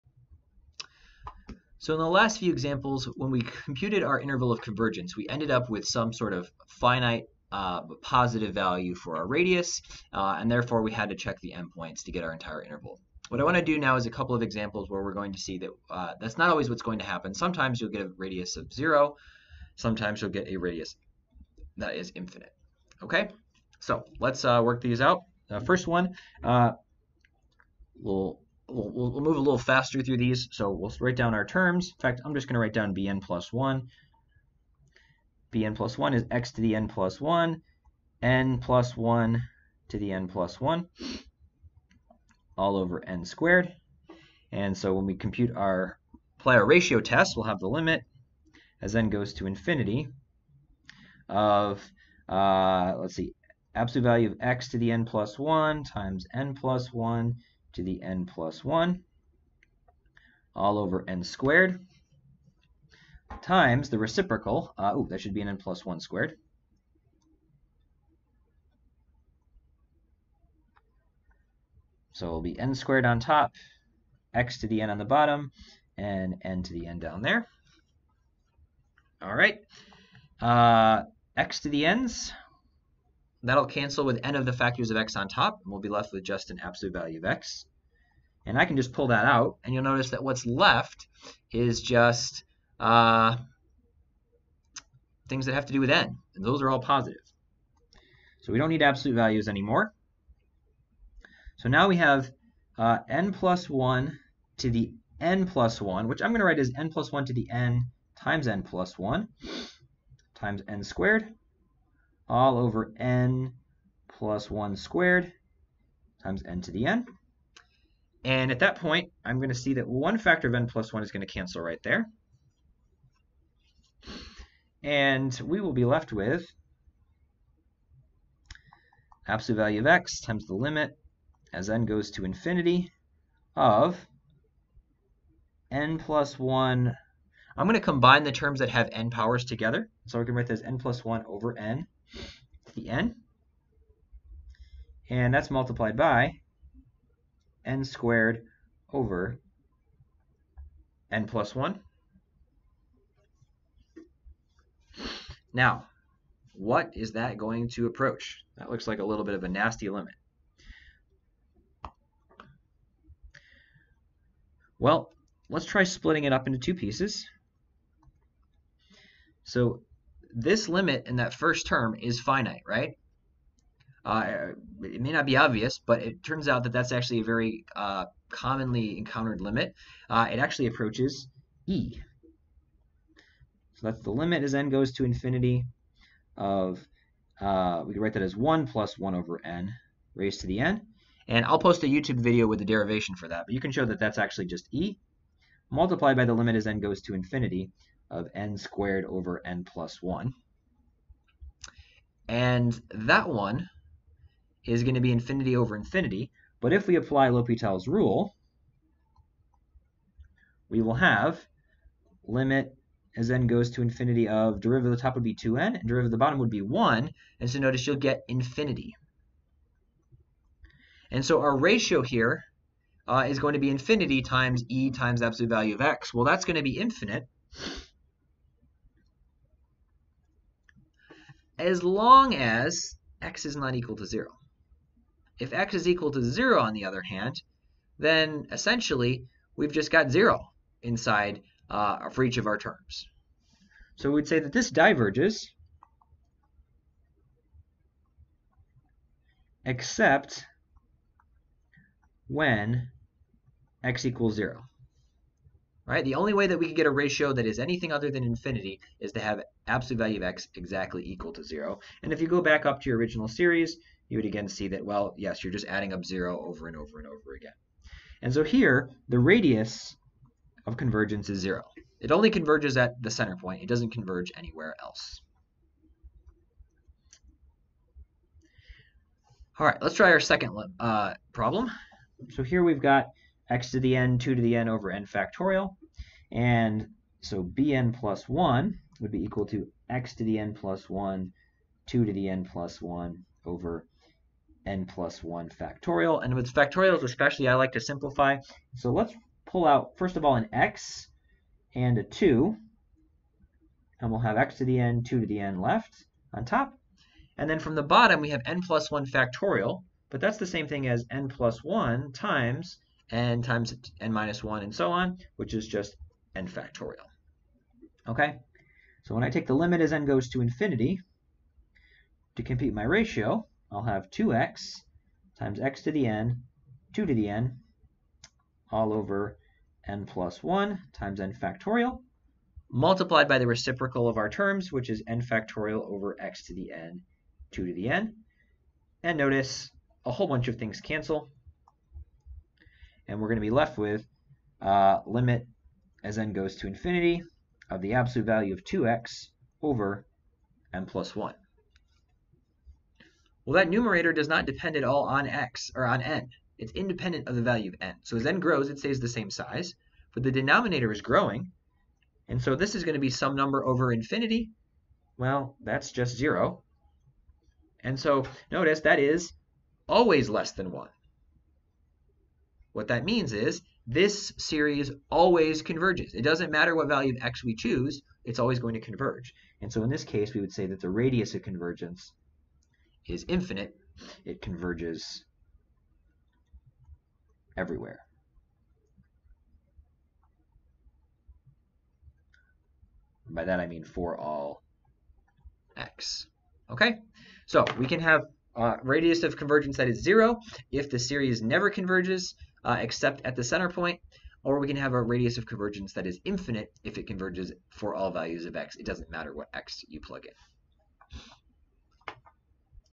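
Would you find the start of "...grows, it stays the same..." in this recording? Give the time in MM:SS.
05:58.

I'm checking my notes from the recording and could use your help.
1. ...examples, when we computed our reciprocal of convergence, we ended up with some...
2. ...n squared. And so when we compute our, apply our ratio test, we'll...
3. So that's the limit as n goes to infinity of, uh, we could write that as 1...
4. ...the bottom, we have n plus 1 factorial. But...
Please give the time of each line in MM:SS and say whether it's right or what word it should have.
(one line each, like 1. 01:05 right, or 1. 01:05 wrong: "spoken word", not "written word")
1. 00:02 wrong: "interval", not "reciprocal"
2. 00:43 right
3. 03:03 right
4. 05:07 right.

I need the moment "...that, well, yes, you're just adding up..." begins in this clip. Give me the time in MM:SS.
04:24.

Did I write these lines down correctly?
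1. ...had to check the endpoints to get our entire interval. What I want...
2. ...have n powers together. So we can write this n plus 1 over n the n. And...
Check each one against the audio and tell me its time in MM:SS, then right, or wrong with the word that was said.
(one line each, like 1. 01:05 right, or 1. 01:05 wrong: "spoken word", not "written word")
1. 00:10 right
2. 02:18 right.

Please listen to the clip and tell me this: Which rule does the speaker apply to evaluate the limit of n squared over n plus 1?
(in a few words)
L'Hopital's rule.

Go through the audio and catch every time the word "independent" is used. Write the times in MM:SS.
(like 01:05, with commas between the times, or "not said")
05:56.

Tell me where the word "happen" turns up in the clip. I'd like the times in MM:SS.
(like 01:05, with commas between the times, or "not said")
00:17.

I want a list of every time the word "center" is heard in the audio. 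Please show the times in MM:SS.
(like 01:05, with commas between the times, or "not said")
04:33, 06:43.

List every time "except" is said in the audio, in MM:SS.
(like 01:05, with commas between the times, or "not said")
04:09, 06:42.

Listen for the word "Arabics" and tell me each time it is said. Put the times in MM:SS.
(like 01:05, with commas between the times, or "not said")
not said.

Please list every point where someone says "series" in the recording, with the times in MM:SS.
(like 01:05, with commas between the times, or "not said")
04:23, 06:14, 06:40.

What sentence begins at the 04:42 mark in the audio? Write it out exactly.
So here we've got x to the n, 2 to the n over n factorial.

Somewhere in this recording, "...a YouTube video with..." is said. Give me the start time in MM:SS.
03:11.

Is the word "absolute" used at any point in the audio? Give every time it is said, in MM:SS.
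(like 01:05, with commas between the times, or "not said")
00:53, 01:26, 01:38, 02:09, 03:45, 04:19, 05:47.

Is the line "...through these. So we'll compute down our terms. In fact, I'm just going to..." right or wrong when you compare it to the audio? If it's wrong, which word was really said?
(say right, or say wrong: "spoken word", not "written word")
wrong: "write", not "compute".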